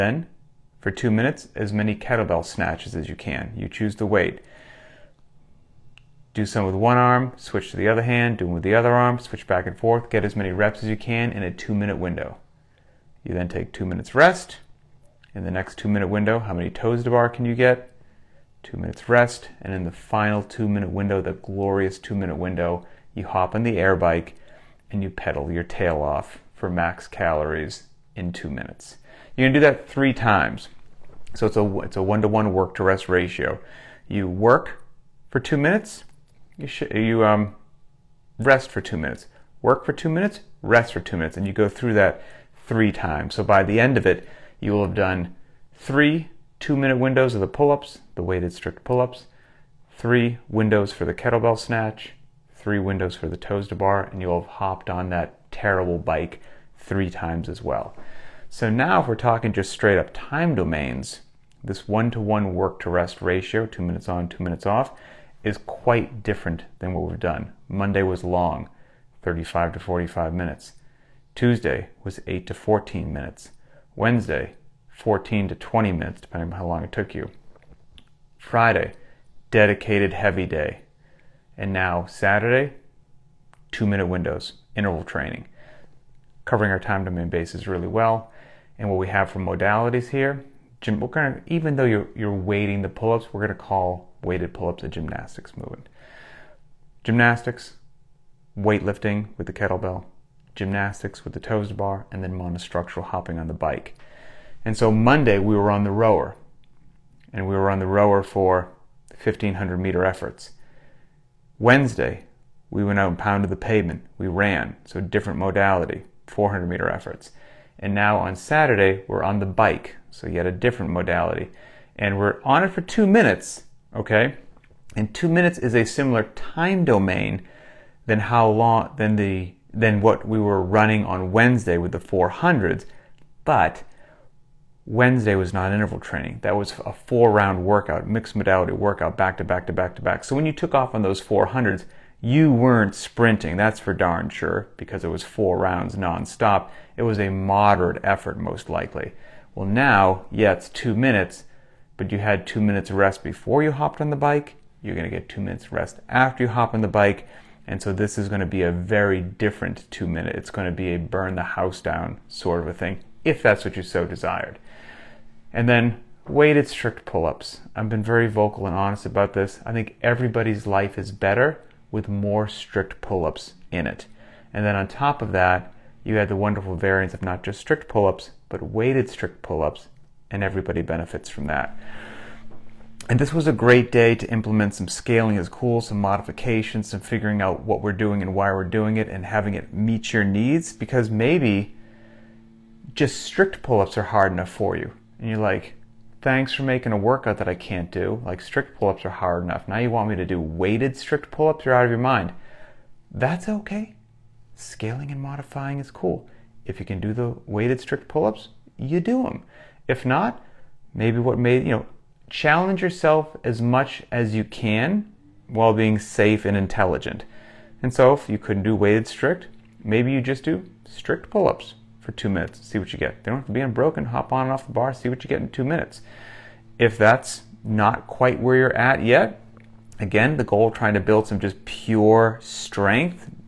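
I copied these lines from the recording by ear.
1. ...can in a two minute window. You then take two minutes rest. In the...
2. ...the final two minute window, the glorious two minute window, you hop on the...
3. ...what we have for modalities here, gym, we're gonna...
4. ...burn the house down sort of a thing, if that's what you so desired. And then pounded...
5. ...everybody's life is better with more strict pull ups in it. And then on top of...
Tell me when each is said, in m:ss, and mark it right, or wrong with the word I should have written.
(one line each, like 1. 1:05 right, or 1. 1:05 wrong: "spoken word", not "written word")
1. 0:10 right
2. 0:19 right
3. 1:28 right
4. 2:40 wrong: "weighted", not "pounded"
5. 2:50 right.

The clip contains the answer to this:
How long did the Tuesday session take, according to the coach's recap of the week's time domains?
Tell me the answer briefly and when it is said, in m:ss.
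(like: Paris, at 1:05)
8 to 14 minutes, at 1:12.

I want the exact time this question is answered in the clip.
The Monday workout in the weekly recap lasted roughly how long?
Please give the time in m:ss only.
1:09.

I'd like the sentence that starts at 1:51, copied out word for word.
Wednesday we went out and pounded the pavement.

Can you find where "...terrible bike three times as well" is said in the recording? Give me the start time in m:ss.
0:55.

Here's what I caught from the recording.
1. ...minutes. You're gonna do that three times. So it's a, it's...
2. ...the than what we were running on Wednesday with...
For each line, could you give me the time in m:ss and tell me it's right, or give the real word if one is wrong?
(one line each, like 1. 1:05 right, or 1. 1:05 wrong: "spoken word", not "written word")
1. 0:28 right
2. 2:09 right.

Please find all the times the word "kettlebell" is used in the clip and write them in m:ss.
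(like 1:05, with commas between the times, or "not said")
0:01, 0:51, 1:39.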